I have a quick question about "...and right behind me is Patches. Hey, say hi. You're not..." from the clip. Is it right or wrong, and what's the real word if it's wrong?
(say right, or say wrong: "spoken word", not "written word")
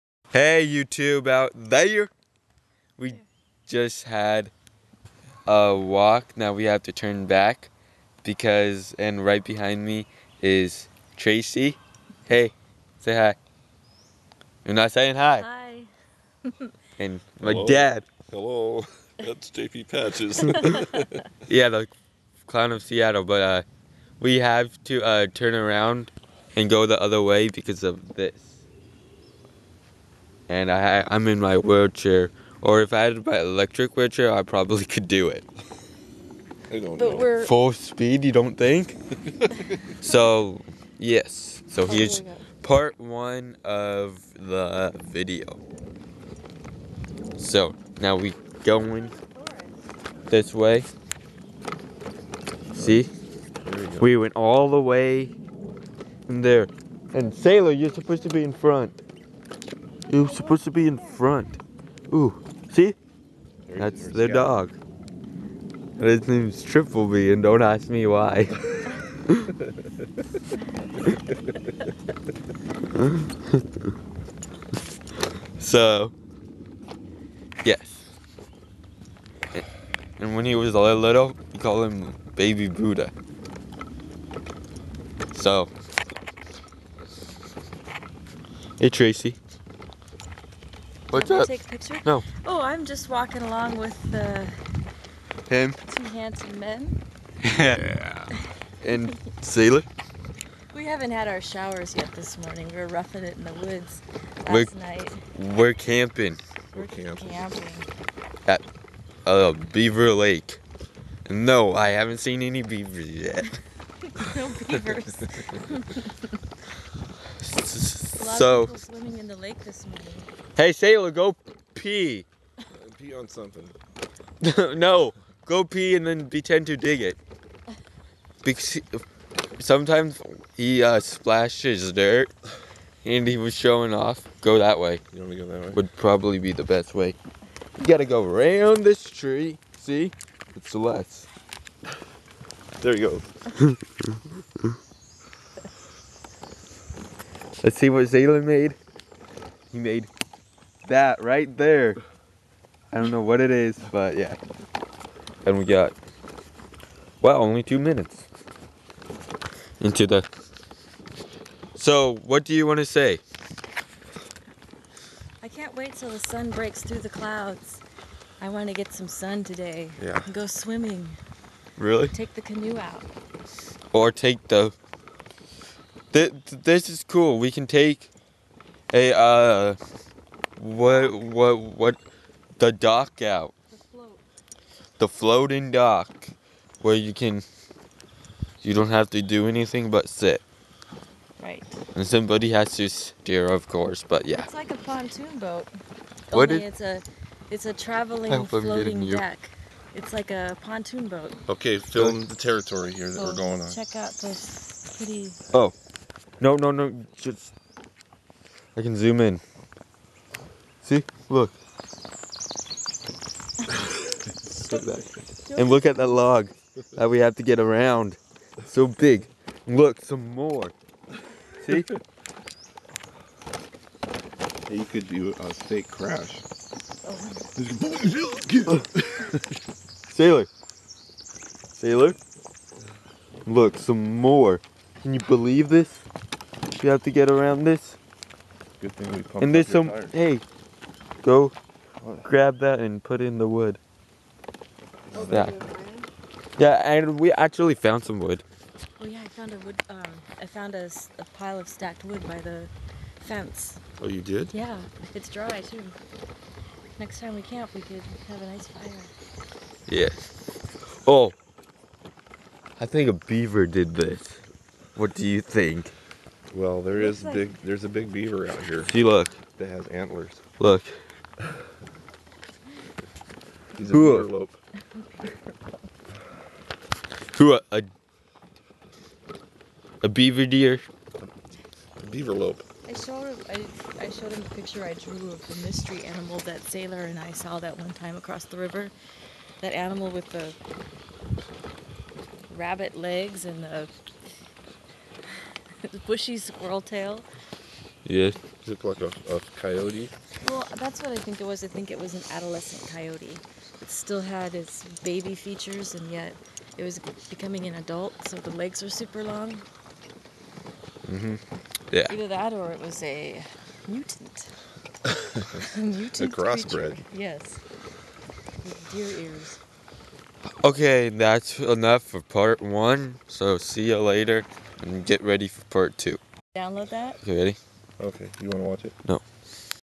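wrong: "Tracy", not "Patches".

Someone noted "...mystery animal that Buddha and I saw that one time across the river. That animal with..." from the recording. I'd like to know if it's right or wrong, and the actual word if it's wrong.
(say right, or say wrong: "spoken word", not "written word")
wrong: "Sailor", not "Buddha".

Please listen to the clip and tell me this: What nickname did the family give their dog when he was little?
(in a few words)
Baby Buddha.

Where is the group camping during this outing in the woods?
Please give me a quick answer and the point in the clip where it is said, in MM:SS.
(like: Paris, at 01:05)
Beaver Lake, at 01:49.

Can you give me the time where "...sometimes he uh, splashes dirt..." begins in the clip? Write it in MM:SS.
02:09.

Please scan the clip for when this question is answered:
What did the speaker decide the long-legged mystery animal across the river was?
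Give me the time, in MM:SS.
05:02.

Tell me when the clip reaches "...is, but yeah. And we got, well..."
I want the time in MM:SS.
02:33.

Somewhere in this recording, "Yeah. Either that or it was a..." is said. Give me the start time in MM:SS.
05:11.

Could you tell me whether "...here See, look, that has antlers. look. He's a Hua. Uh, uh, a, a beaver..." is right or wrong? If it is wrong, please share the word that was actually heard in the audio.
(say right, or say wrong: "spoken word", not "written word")
right.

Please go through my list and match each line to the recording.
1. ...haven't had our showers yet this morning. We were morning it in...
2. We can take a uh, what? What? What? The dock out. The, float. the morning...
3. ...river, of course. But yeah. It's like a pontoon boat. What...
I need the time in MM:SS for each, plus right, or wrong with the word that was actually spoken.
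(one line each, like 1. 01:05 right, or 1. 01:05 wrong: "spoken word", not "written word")
1. 01:40 wrong: "roughing", not "morning"
2. 02:57 wrong: "floating", not "morning"
3. 03:12 wrong: "steer", not "river".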